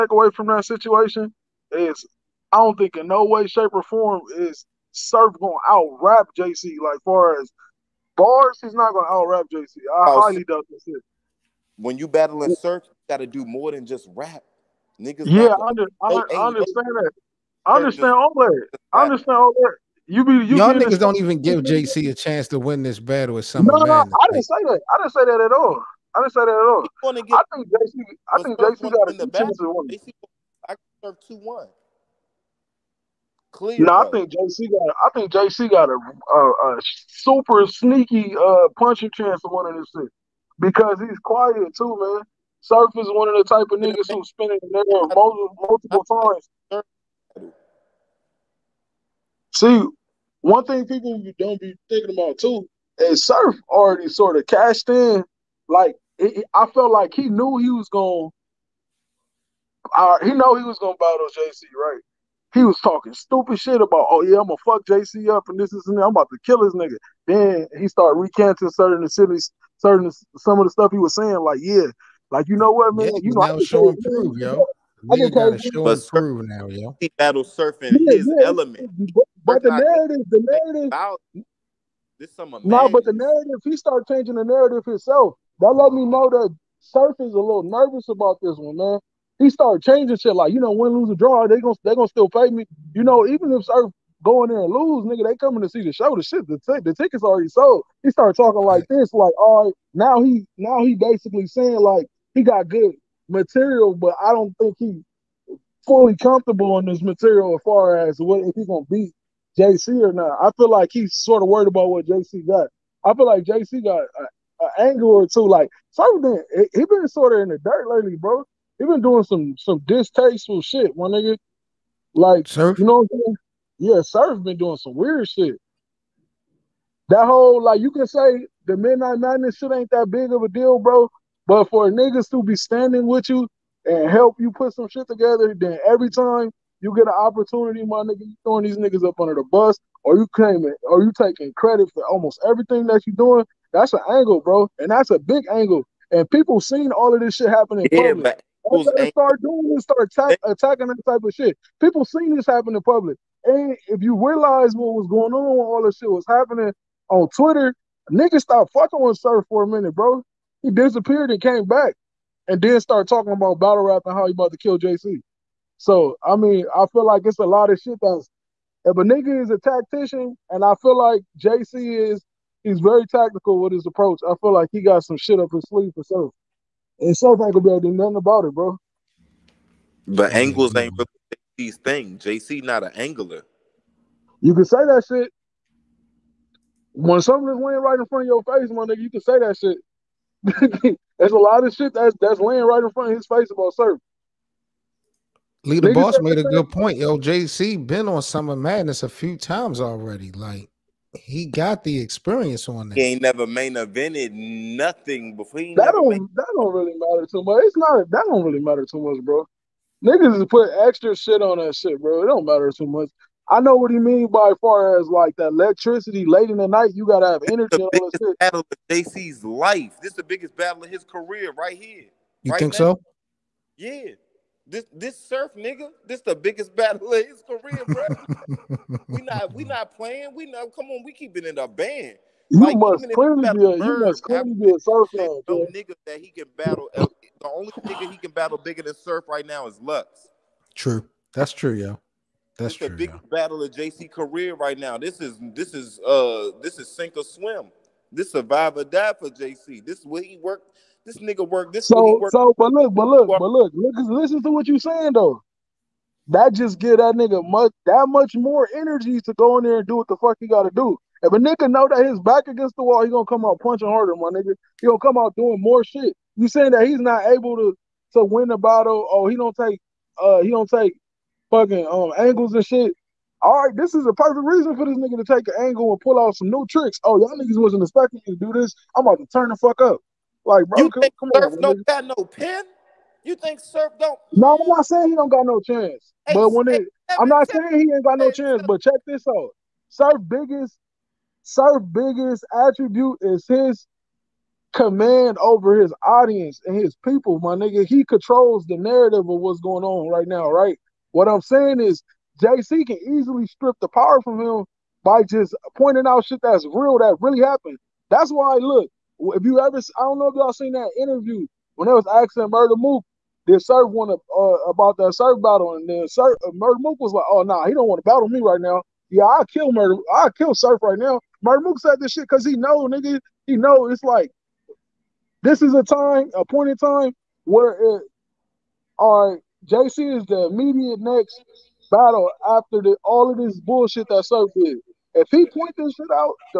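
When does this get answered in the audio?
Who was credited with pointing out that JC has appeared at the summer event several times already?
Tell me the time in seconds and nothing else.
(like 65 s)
195 s.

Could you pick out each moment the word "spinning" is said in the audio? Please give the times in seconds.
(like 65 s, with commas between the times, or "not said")
44 s.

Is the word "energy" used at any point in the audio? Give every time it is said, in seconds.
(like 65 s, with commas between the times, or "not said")
217 s, 258 s.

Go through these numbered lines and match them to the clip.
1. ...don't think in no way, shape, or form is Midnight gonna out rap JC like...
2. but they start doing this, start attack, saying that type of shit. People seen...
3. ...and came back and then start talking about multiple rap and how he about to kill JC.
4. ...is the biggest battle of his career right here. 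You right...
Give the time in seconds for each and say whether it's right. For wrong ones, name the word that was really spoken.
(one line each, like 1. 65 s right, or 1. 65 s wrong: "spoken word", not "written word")
1. 2 s wrong: "Surf", not "Midnight"
2. 148 s wrong: "attacking", not "saying"
3. 161 s wrong: "battle", not "multiple"
4. 220 s right.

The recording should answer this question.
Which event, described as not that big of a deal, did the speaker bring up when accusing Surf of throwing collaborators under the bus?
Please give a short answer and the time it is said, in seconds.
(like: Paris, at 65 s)
Midnight Madness, at 128 s.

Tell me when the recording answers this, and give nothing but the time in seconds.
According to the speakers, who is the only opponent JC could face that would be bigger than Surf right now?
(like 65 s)
239 s.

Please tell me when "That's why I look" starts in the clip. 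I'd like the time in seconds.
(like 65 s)
308 s.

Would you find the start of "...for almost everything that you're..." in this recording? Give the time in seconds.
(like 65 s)
141 s.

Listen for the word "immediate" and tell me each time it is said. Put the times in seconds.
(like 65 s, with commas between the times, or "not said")
330 s.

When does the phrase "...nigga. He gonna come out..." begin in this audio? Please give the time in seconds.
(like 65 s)
264 s.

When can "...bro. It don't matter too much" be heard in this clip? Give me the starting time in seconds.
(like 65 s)
212 s.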